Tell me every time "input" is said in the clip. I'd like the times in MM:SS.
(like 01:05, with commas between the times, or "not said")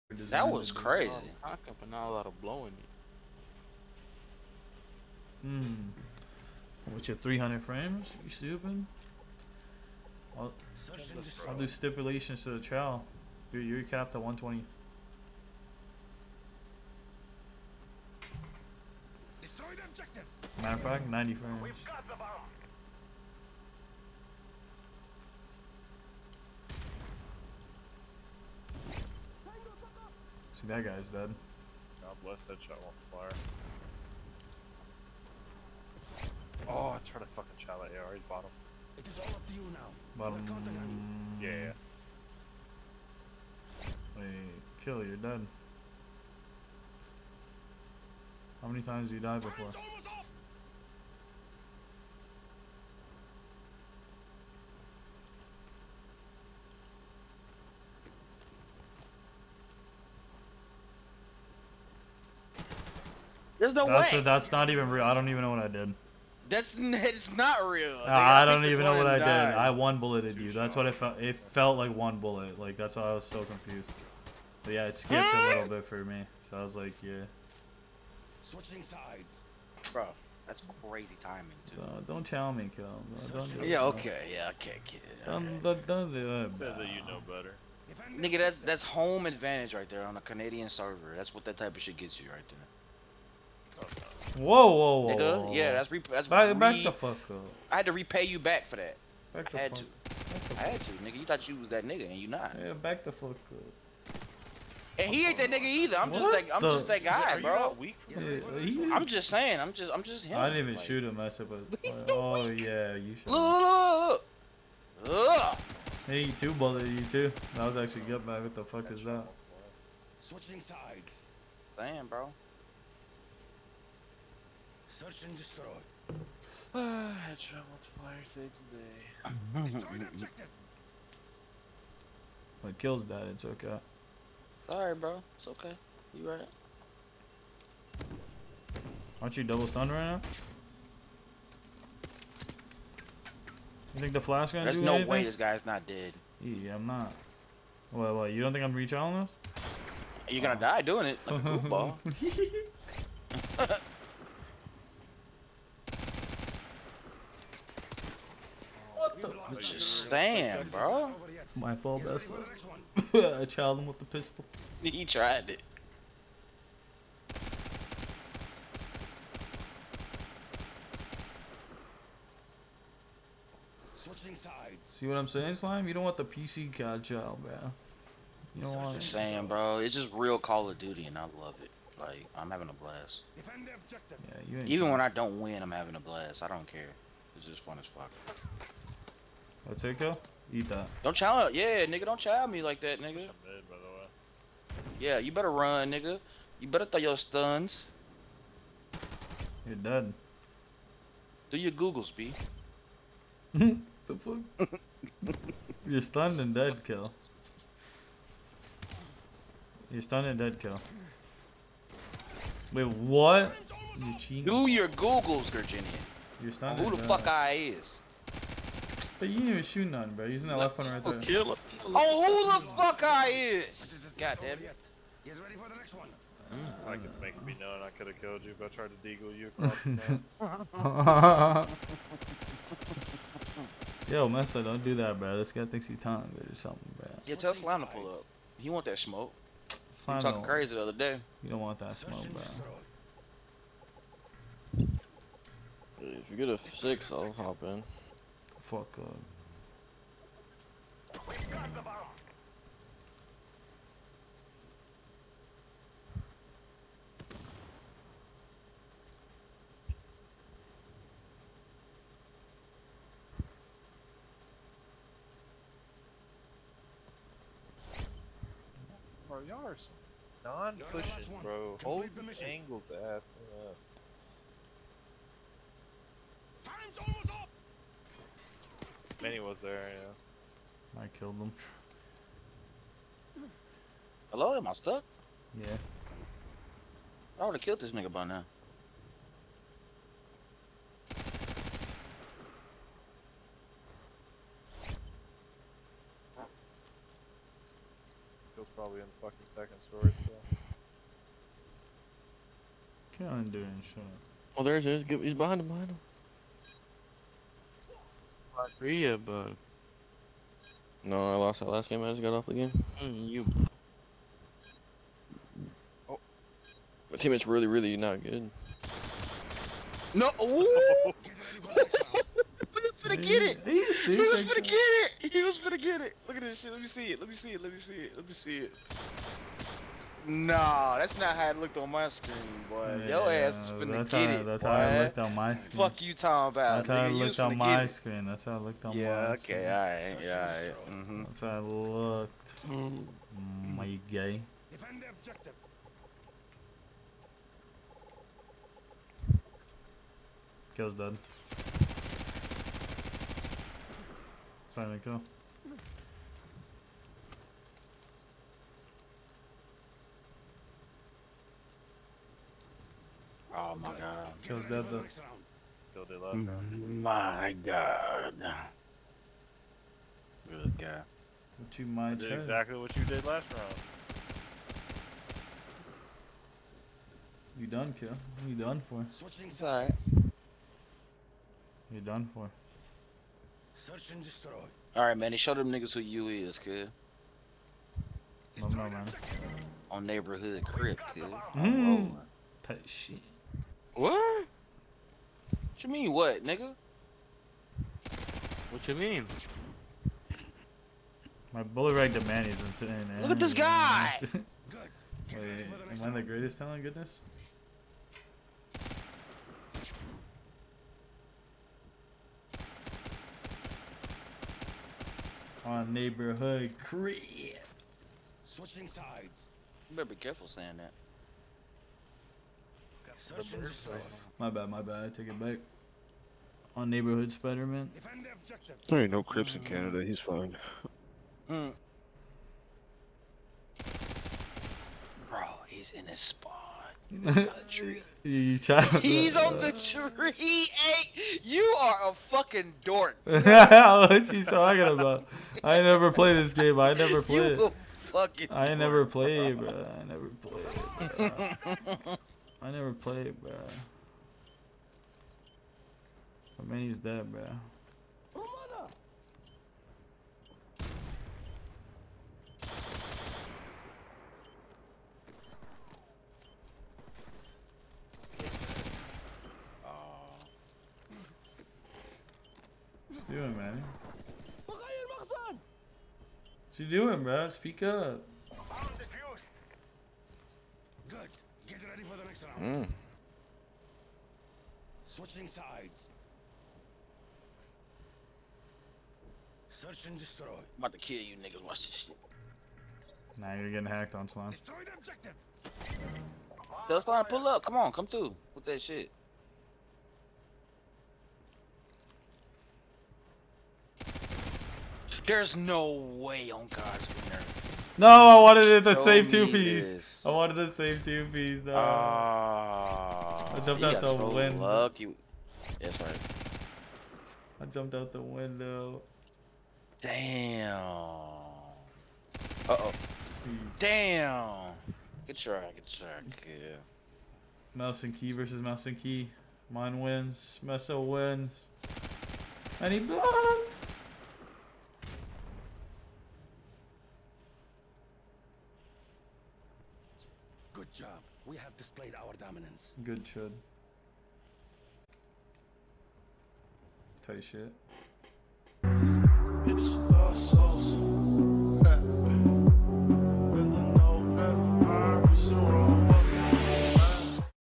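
not said.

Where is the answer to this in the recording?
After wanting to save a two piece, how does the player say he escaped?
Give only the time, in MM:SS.
08:37.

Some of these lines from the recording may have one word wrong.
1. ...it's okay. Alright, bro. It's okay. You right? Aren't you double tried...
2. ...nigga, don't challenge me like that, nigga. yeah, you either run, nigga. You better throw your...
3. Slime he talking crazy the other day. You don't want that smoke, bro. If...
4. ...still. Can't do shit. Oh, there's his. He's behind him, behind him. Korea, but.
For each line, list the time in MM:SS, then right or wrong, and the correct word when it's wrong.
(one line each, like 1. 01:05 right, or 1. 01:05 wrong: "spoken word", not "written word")
1. 02:13 wrong: "stunned", not "tried"
2. 03:11 wrong: "better", not "either"
3. 03:59 right
4. 05:00 right.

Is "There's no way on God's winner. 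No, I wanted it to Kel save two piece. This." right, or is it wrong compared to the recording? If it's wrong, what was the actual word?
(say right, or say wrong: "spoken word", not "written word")
wrong: "Show", not "Kel".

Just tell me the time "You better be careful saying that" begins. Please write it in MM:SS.
06:59.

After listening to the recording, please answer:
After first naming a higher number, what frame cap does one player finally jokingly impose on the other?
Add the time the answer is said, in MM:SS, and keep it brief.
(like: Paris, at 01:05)
90, at 00:21.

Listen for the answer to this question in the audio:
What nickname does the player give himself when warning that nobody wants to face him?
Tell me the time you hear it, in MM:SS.
02:56.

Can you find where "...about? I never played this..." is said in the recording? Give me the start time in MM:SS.
07:24.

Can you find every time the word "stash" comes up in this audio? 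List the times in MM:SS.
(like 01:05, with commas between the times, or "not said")
not said.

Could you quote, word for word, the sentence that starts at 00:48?
How many times do you die before?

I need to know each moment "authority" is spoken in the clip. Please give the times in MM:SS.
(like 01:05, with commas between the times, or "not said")
not said.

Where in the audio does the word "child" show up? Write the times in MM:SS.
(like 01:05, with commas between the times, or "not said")
02:43, 02:57.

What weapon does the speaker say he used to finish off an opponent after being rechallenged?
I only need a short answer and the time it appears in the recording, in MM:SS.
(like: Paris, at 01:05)
pistol, at 02:44.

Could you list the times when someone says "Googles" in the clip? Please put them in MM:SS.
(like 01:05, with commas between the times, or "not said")
03:21, 03:34.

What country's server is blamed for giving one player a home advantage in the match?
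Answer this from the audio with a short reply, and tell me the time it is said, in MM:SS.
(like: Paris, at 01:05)
Canada, at 01:30.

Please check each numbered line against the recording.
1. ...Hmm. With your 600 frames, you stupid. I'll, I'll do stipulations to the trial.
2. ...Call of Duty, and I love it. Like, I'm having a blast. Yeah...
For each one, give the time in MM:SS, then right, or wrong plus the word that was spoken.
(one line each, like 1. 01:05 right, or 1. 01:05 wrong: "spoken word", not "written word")
1. 00:05 wrong: "300", not "600"
2. 03:00 right.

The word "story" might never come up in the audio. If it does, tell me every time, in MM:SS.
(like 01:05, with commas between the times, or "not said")
04:59.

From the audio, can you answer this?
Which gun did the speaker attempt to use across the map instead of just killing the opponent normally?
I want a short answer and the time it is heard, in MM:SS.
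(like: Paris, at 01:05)
deagle, at 03:49.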